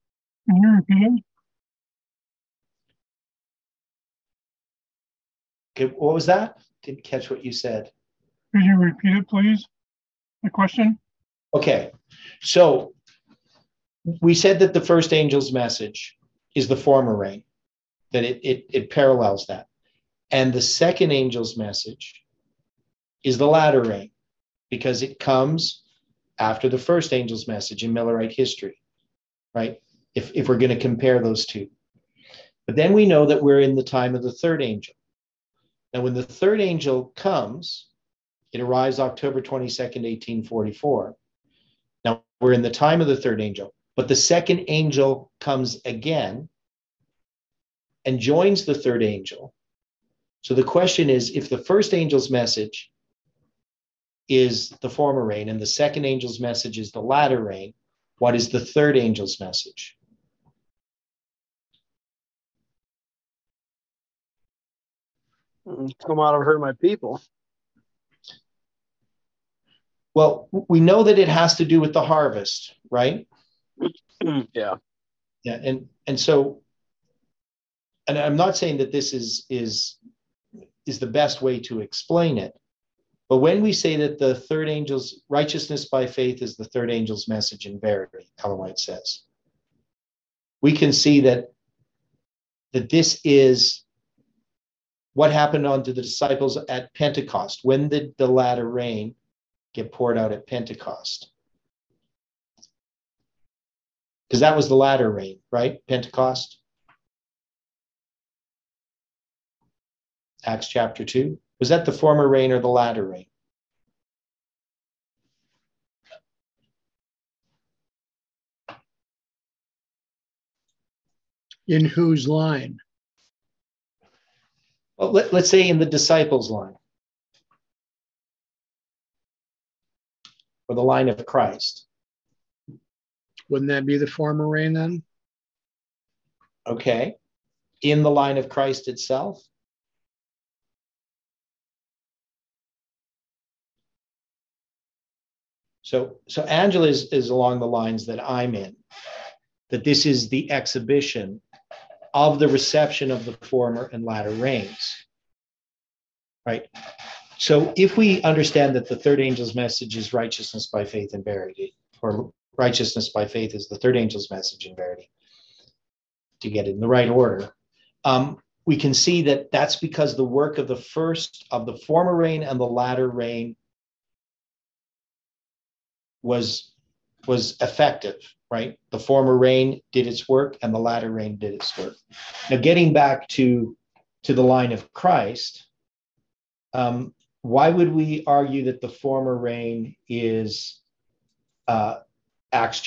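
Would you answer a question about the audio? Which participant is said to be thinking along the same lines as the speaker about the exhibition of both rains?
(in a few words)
Angela.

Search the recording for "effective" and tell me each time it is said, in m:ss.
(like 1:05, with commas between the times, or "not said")
2:57.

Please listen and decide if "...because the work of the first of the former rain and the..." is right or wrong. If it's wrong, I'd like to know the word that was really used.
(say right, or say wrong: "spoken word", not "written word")
right.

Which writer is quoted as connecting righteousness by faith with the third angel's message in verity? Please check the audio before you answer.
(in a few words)
Ellen White.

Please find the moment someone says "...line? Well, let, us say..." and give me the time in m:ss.
2:02.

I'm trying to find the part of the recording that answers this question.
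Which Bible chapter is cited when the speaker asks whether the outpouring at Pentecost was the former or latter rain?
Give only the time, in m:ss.
1:50.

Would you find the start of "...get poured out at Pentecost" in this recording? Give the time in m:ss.
1:39.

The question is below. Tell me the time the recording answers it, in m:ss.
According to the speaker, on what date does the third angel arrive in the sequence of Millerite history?
0:38.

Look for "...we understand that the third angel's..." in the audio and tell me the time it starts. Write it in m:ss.
2:37.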